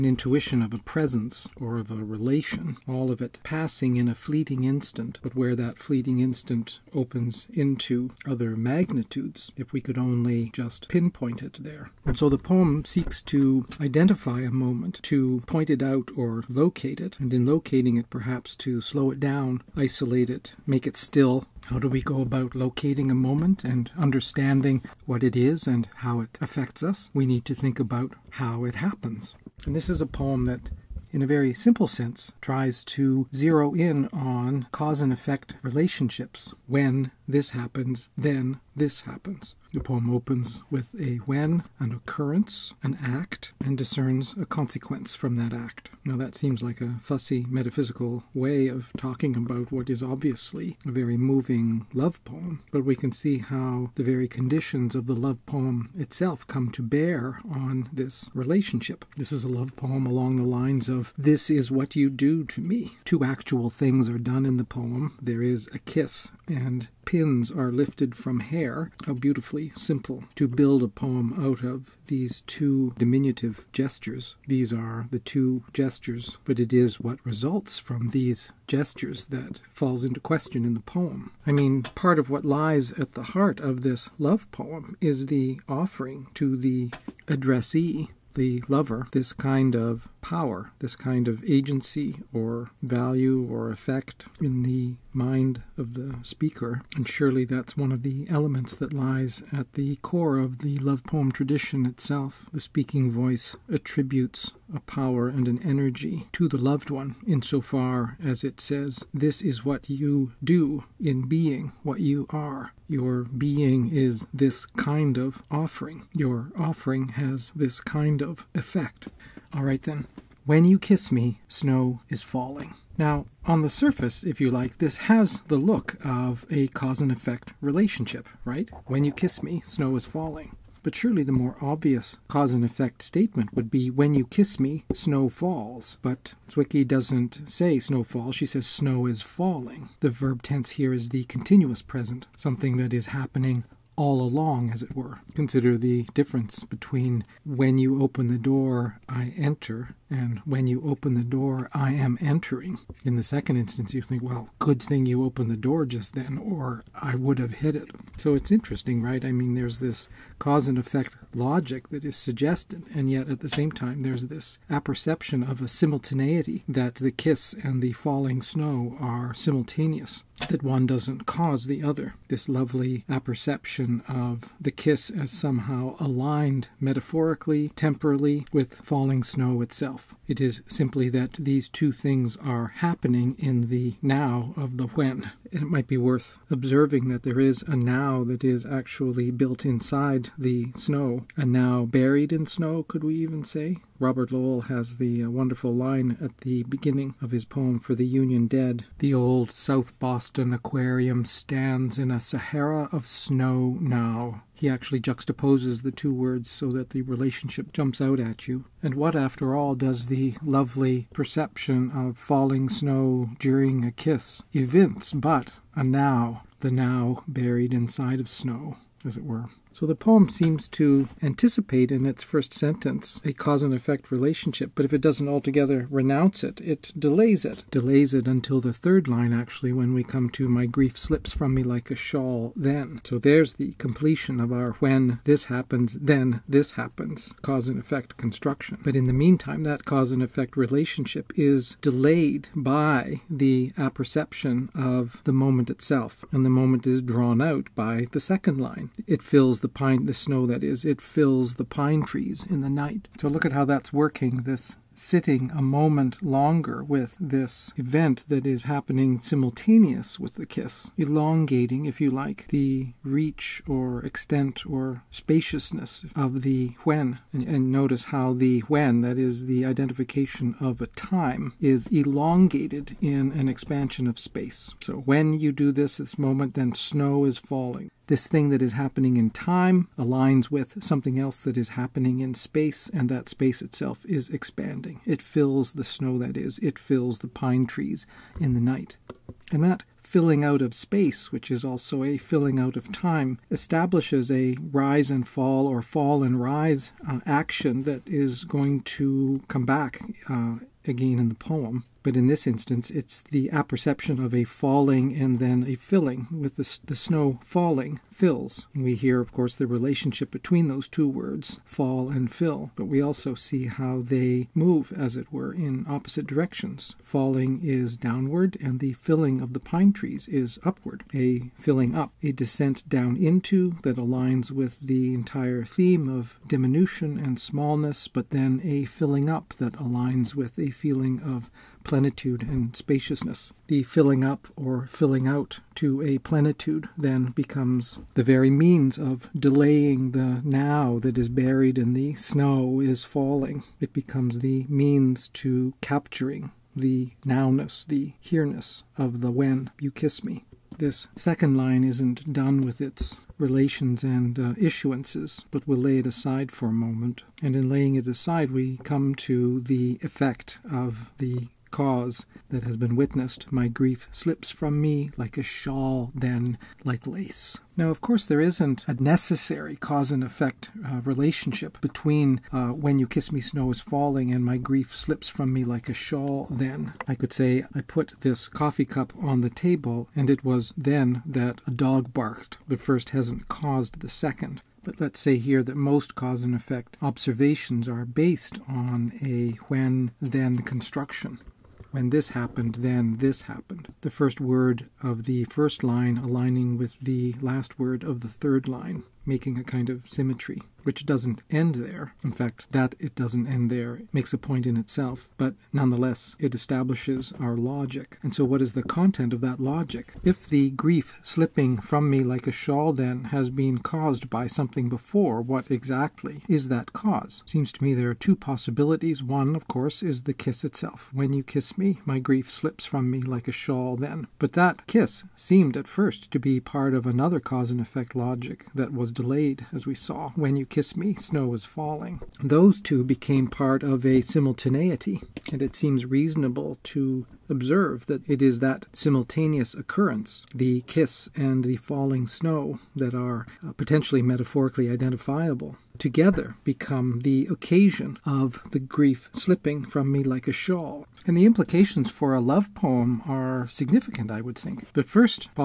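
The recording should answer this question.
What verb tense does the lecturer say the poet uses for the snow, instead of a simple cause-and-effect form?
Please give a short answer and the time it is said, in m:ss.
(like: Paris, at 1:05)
continuous present, at 2:21.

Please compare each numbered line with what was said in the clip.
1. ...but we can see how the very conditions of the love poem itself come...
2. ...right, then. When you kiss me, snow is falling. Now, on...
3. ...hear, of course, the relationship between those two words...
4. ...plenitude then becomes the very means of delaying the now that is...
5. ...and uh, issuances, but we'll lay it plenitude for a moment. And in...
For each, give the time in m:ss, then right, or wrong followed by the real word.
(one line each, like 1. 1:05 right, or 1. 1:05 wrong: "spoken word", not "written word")
1. 0:52 right
2. 1:59 right
3. 5:08 right
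4. 5:36 right
5. 5:54 wrong: "aside", not "plenitude".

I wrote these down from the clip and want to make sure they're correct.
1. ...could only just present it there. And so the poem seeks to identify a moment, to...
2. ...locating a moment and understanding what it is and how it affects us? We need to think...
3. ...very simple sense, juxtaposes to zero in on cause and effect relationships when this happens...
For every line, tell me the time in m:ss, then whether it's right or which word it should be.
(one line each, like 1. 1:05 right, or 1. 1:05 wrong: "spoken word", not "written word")
1. 0:09 wrong: "pinpoint", not "present"
2. 0:22 right
3. 0:31 wrong: "tries", not "juxtaposes".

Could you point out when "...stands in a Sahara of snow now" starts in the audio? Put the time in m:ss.
3:21.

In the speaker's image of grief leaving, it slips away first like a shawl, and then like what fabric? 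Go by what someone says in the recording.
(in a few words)
lace.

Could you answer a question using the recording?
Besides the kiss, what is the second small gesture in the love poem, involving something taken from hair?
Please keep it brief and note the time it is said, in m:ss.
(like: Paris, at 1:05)
pins, at 1:07.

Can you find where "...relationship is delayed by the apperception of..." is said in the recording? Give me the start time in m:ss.
4:00.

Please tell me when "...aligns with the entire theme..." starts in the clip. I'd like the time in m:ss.
5:23.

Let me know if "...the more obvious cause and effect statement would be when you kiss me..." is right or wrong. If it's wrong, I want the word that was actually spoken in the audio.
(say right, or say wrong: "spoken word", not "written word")
right.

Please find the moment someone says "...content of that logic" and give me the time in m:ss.
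6:48.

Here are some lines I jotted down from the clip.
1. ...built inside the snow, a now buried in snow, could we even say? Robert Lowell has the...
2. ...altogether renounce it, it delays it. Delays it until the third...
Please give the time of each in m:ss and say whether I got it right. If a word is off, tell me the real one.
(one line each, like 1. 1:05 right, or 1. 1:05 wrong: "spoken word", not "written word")
1. 3:09 right
2. 3:45 right.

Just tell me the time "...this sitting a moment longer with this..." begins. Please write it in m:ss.
4:14.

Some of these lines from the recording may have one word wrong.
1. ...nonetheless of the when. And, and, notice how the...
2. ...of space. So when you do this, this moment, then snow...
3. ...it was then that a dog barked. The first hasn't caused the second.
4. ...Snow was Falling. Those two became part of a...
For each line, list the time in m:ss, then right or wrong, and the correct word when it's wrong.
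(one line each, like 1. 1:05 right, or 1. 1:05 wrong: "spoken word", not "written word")
1. 4:25 wrong: "spaciousness", not "nonetheless"
2. 4:34 right
3. 6:20 right
4. 7:11 right.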